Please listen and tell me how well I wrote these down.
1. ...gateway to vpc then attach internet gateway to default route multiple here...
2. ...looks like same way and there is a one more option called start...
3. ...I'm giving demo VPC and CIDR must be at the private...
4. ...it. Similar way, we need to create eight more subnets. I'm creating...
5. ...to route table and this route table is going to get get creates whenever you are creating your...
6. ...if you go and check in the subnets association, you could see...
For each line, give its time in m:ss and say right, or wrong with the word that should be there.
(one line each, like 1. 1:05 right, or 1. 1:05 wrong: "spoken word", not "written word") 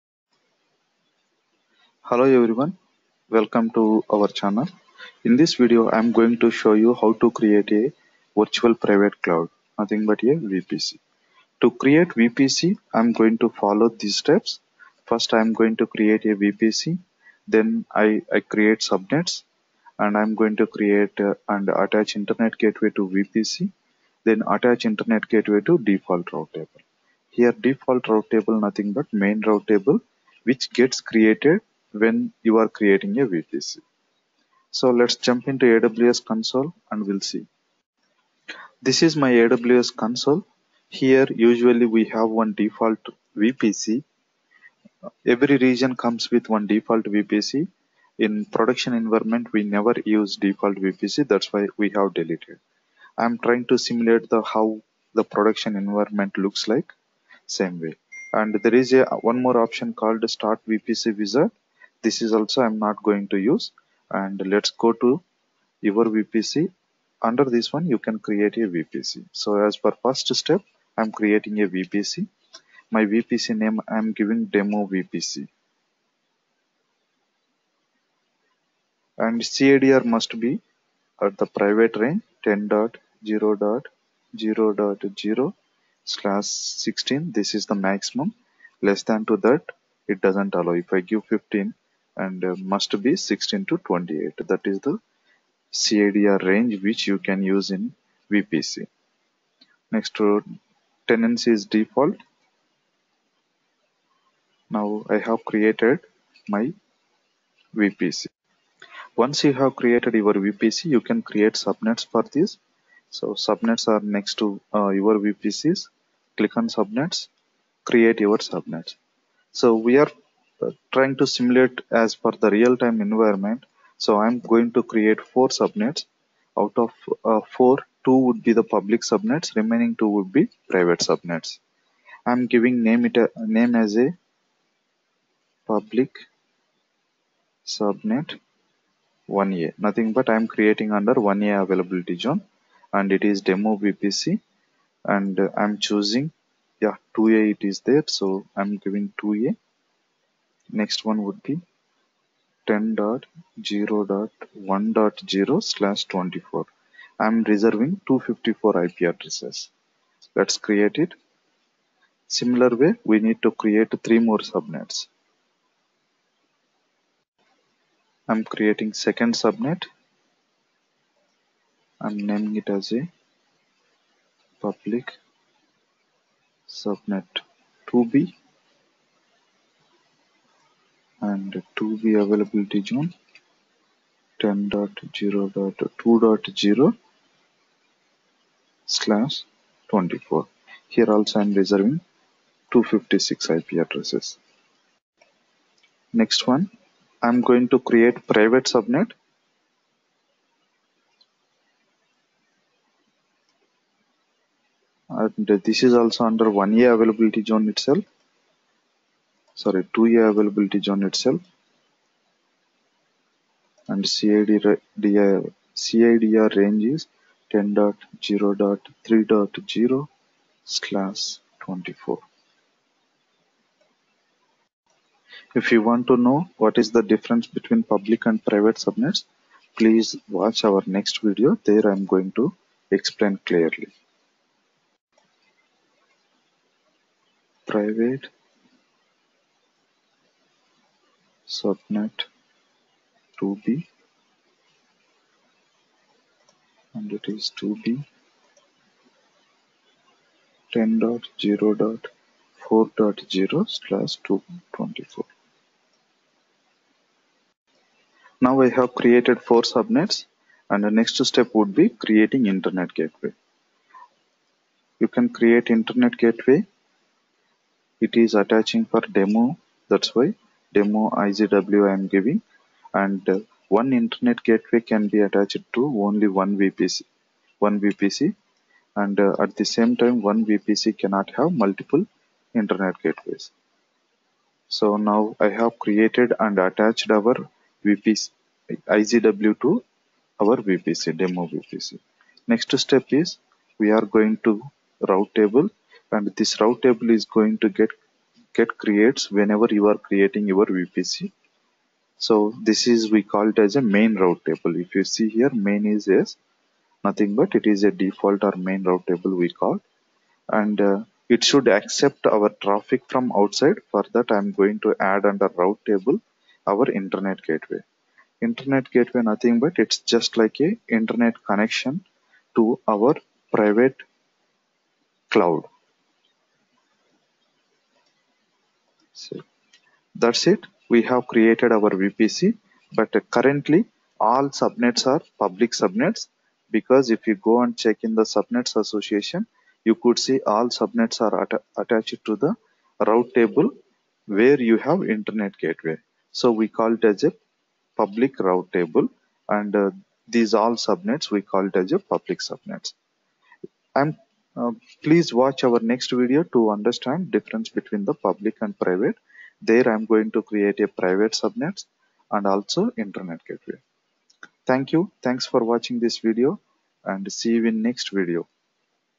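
1. 0:22 wrong: "table", not "multiple"
2. 0:56 right
3. 1:13 right
4. 2:40 wrong: "three", not "eight"
5. 4:54 right
6. 5:37 right.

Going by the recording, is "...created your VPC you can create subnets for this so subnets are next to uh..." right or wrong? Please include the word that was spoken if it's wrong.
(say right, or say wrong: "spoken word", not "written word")
right.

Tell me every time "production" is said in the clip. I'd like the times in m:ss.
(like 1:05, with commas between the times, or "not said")
0:48, 0:55.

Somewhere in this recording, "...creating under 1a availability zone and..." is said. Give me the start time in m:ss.
2:20.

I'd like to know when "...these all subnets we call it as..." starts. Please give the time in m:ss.
5:50.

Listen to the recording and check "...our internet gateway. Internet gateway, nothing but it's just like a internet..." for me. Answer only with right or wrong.
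right.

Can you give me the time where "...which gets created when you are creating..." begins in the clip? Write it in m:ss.
0:30.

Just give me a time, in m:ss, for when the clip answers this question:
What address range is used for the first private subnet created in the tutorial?
3:37.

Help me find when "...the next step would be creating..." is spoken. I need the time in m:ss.
4:20.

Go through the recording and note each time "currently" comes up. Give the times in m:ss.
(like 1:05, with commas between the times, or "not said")
5:33.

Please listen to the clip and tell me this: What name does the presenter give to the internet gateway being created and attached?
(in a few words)
demo IGW.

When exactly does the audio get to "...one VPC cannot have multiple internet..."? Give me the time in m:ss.
4:40.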